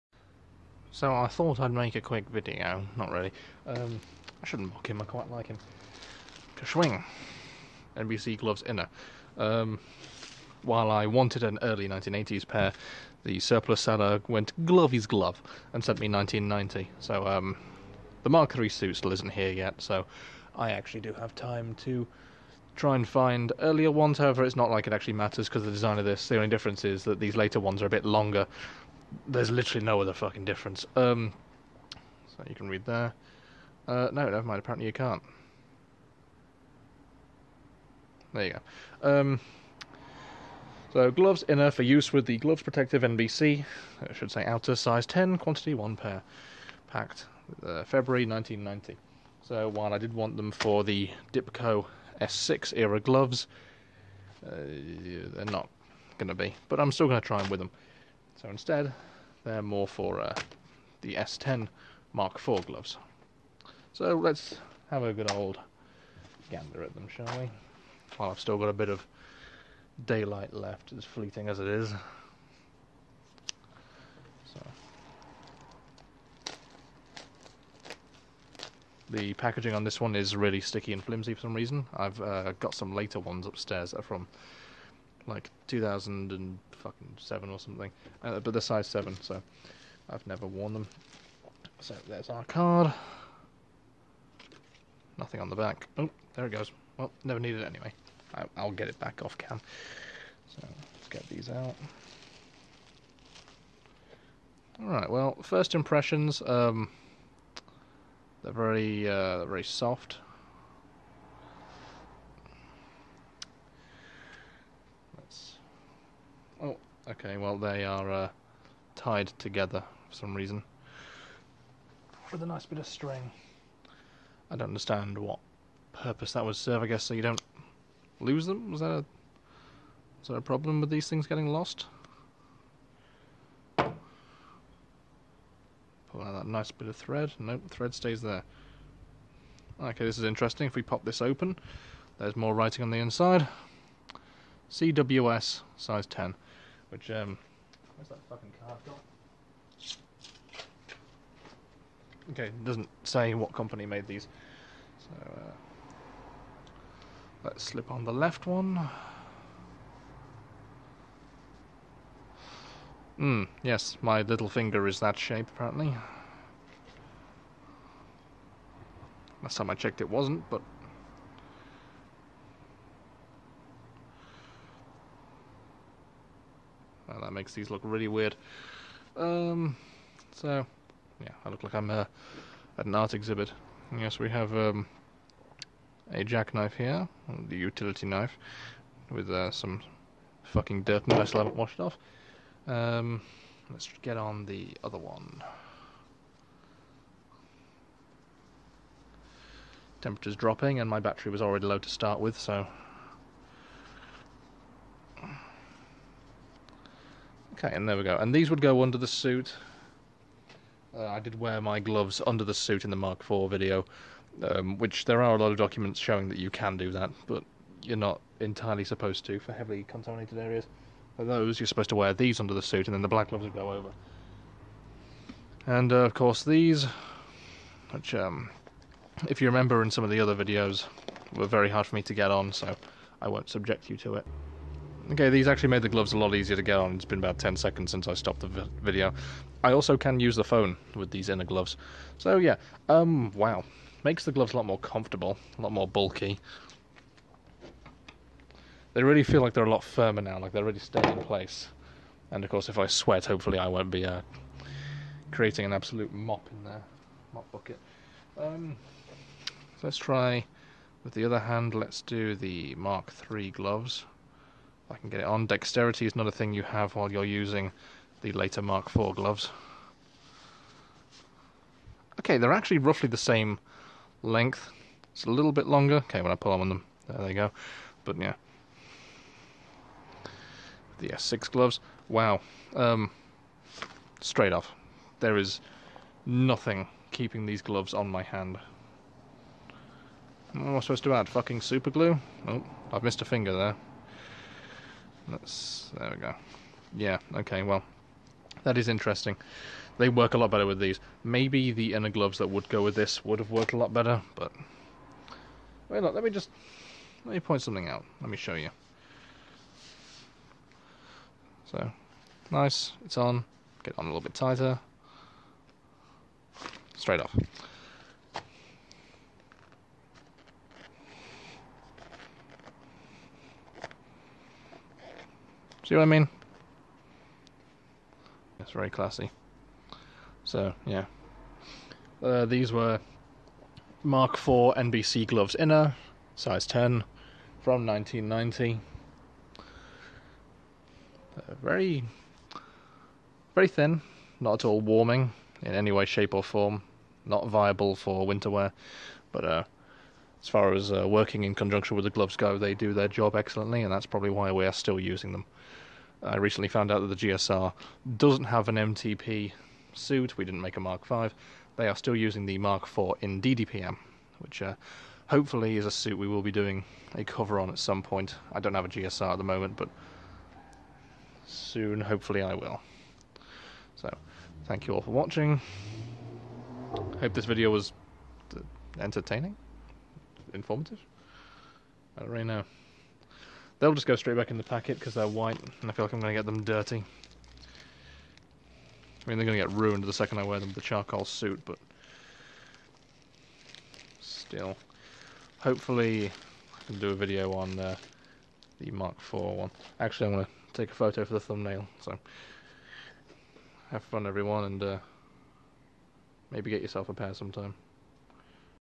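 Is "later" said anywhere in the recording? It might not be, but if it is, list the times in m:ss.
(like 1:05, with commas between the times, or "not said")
0:27, 1:22, 4:28.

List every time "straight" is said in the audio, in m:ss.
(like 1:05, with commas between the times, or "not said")
4:44, 5:16, 6:24.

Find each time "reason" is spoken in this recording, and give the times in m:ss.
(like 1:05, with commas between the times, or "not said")
1:21, 2:00.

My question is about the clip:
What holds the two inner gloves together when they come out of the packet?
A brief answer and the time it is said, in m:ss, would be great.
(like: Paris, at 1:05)
string, at 2:02.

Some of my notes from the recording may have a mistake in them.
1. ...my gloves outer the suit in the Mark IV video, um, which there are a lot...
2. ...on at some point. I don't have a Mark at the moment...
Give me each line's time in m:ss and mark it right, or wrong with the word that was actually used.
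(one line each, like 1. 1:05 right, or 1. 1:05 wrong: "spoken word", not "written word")
1. 3:31 wrong: "under", not "outer"
2. 6:07 wrong: "GSR", not "Mark".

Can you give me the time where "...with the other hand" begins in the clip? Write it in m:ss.
4:21.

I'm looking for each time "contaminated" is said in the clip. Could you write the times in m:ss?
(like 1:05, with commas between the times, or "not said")
3:39.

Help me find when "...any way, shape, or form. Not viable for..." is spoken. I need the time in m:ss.
5:45.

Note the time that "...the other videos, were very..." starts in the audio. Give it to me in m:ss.
3:50.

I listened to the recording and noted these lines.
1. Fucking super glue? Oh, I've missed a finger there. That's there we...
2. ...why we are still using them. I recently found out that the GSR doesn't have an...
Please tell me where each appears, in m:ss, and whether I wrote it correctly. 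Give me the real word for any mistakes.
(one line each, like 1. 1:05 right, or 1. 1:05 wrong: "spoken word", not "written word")
1. 4:51 right
2. 5:54 right.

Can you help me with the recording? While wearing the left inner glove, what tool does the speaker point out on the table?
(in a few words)
utility knife.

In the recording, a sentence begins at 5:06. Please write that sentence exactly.
Let me just let me point something out.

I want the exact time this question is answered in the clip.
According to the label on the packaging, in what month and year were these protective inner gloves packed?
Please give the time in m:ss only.
0:47.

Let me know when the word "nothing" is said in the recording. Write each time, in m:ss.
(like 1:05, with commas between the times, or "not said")
1:35, 4:46.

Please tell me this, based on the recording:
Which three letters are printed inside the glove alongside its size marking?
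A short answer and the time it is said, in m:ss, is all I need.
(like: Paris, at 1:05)
CWS, at 2:24.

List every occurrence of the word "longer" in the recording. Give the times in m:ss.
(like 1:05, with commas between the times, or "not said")
0:28, 4:35.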